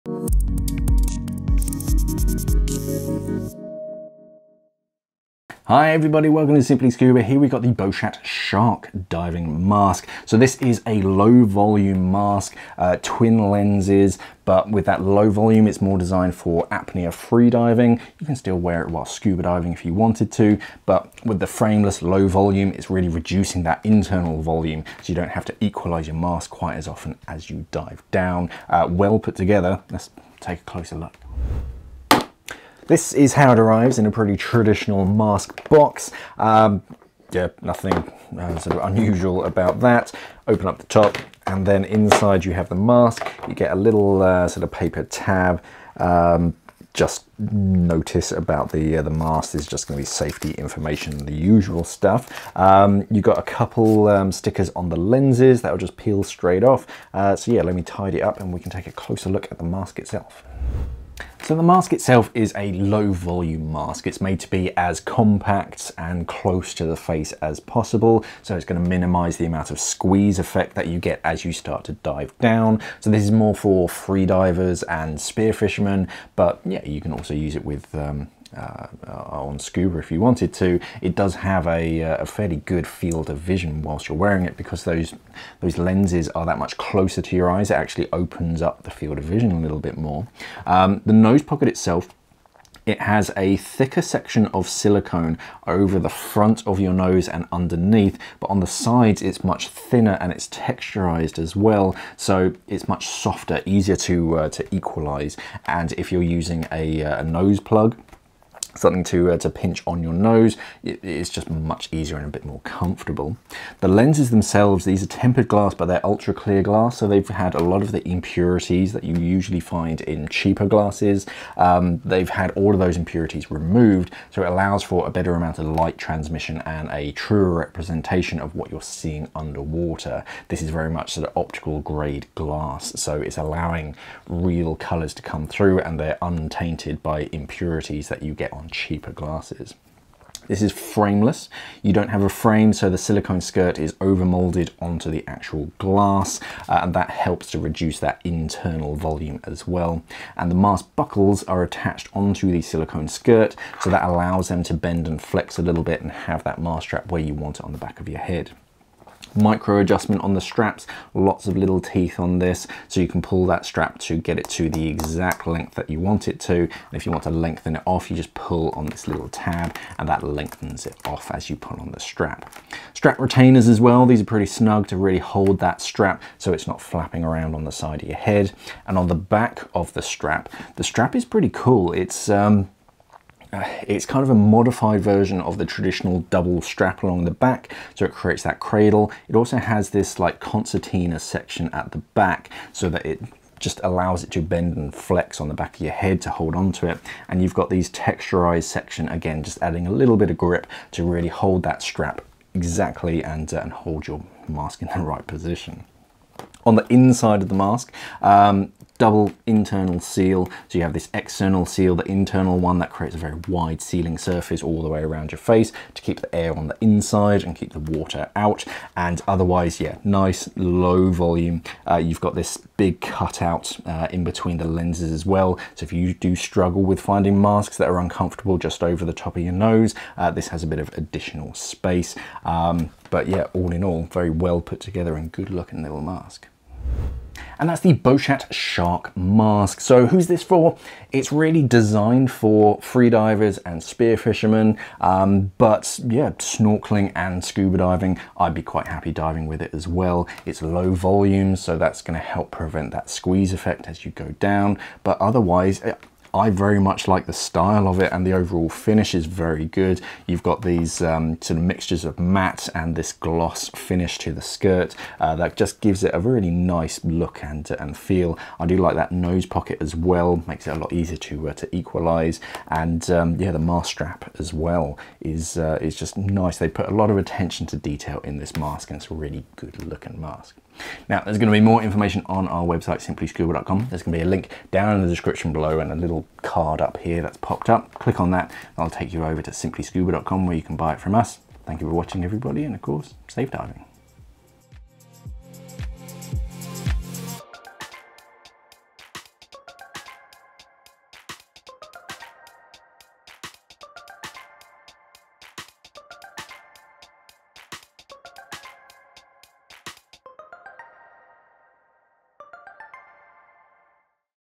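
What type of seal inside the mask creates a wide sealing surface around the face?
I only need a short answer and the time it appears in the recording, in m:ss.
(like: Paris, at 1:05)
double internal seal, at 3:29.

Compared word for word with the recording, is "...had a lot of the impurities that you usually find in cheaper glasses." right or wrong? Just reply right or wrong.
right.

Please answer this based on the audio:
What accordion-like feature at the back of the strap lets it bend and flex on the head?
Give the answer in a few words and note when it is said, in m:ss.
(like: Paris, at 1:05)
concertina section, at 3:10.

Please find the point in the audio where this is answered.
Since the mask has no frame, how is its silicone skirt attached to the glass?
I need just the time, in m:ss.
2:23.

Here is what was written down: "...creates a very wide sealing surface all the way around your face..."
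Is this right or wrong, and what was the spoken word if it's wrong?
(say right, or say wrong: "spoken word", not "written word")
right.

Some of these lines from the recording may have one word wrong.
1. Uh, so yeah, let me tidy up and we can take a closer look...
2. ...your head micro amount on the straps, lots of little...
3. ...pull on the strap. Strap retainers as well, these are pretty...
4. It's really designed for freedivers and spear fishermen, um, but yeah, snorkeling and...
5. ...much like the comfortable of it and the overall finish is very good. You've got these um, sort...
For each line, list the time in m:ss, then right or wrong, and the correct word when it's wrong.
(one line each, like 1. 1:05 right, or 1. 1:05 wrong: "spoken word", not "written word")
1. 0:57 right
2. 2:38 wrong: "adjustment", not "amount"
3. 2:51 right
4. 4:01 right
5. 4:16 wrong: "style", not "comfortable".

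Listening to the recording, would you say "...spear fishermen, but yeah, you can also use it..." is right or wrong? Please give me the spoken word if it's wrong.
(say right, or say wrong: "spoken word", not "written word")
right.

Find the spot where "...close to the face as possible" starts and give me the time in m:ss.
1:06.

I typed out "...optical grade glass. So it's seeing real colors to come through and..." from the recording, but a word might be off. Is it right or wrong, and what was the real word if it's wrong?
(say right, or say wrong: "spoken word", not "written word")
wrong: "allowing", not "seeing".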